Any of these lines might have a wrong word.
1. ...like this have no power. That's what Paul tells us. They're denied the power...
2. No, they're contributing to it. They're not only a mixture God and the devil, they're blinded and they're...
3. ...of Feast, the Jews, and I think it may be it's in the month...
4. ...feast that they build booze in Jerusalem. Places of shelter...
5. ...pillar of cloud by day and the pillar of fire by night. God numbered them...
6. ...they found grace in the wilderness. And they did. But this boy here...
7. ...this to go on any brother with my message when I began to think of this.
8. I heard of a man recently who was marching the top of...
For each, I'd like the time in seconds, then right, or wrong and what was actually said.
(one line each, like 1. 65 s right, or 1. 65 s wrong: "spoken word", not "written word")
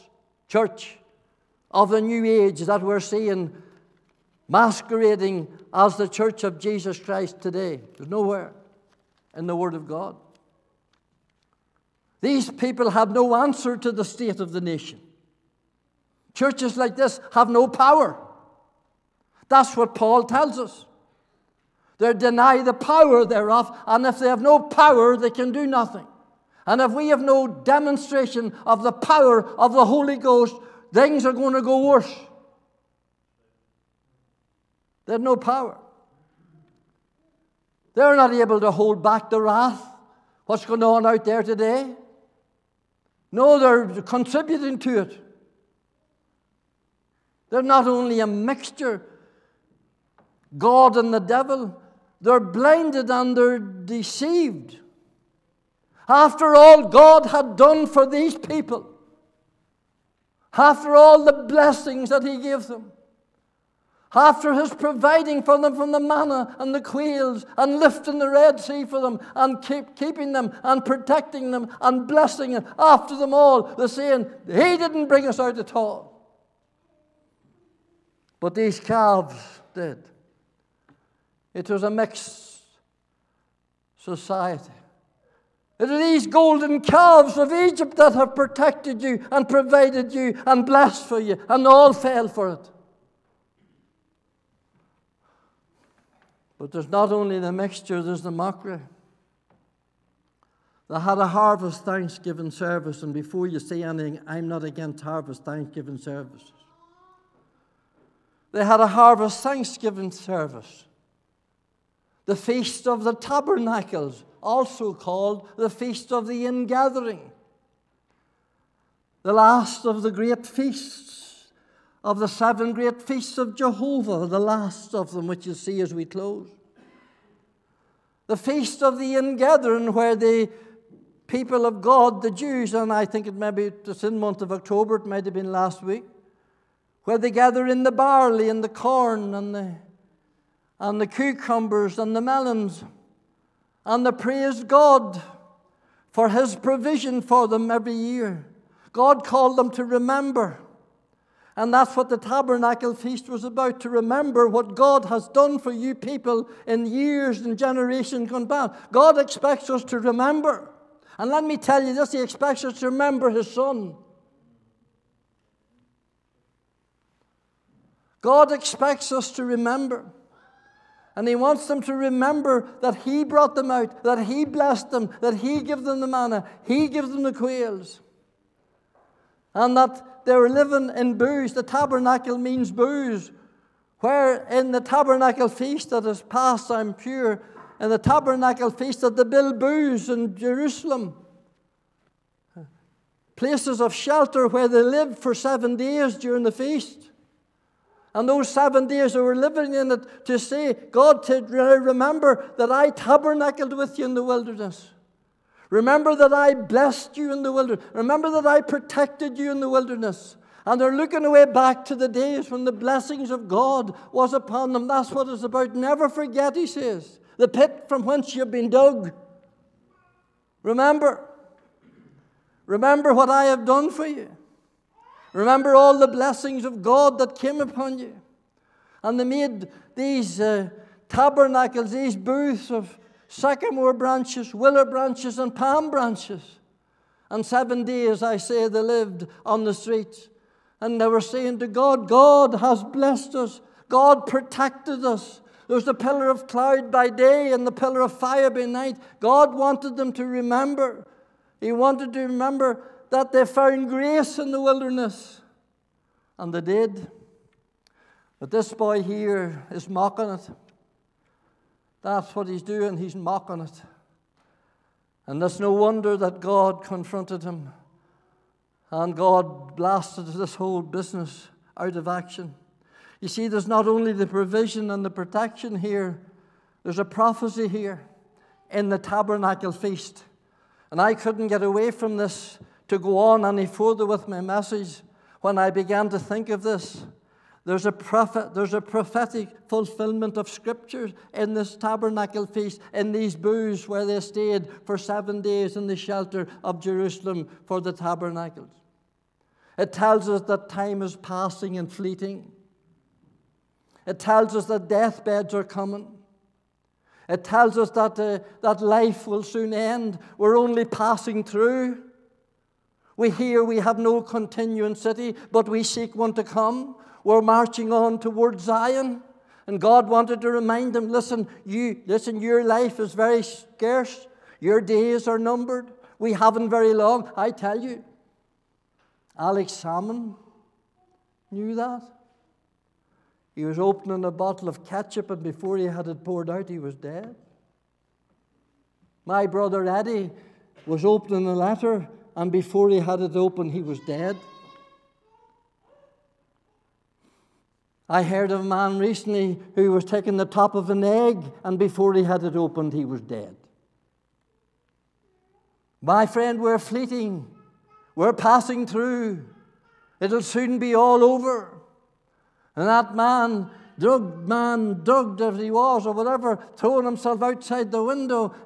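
1. 16 s right
2. 43 s right
3. 131 s wrong: "God", not "Feast"
4. 188 s right
5. 245 s wrong: "wanted", not "numbered"
6. 253 s right
7. 282 s wrong: "further", not "brother"
8. 348 s wrong: "taking", not "marching".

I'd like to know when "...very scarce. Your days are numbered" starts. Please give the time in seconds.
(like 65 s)
323 s.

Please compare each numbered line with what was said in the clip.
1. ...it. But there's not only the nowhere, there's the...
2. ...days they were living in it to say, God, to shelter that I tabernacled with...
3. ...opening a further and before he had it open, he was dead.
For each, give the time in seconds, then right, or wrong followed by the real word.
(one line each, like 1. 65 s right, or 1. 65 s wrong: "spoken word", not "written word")
1. 92 s wrong: "mixture", not "nowhere"
2. 198 s wrong: "remember", not "shelter"
3. 341 s wrong: "letter", not "further".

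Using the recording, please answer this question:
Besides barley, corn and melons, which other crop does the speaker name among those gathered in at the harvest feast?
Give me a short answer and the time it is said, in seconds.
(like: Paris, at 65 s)
Cucumbers, at 141 s.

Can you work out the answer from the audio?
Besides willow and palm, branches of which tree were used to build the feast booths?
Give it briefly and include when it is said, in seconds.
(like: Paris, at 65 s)
Sycamore, at 233 s.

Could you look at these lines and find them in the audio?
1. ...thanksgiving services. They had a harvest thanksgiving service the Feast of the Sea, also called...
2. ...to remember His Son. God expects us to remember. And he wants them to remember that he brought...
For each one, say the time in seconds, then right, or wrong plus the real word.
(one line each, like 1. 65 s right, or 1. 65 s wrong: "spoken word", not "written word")
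1. 105 s wrong: "Tabernacles", not "Sea"
2. 162 s right.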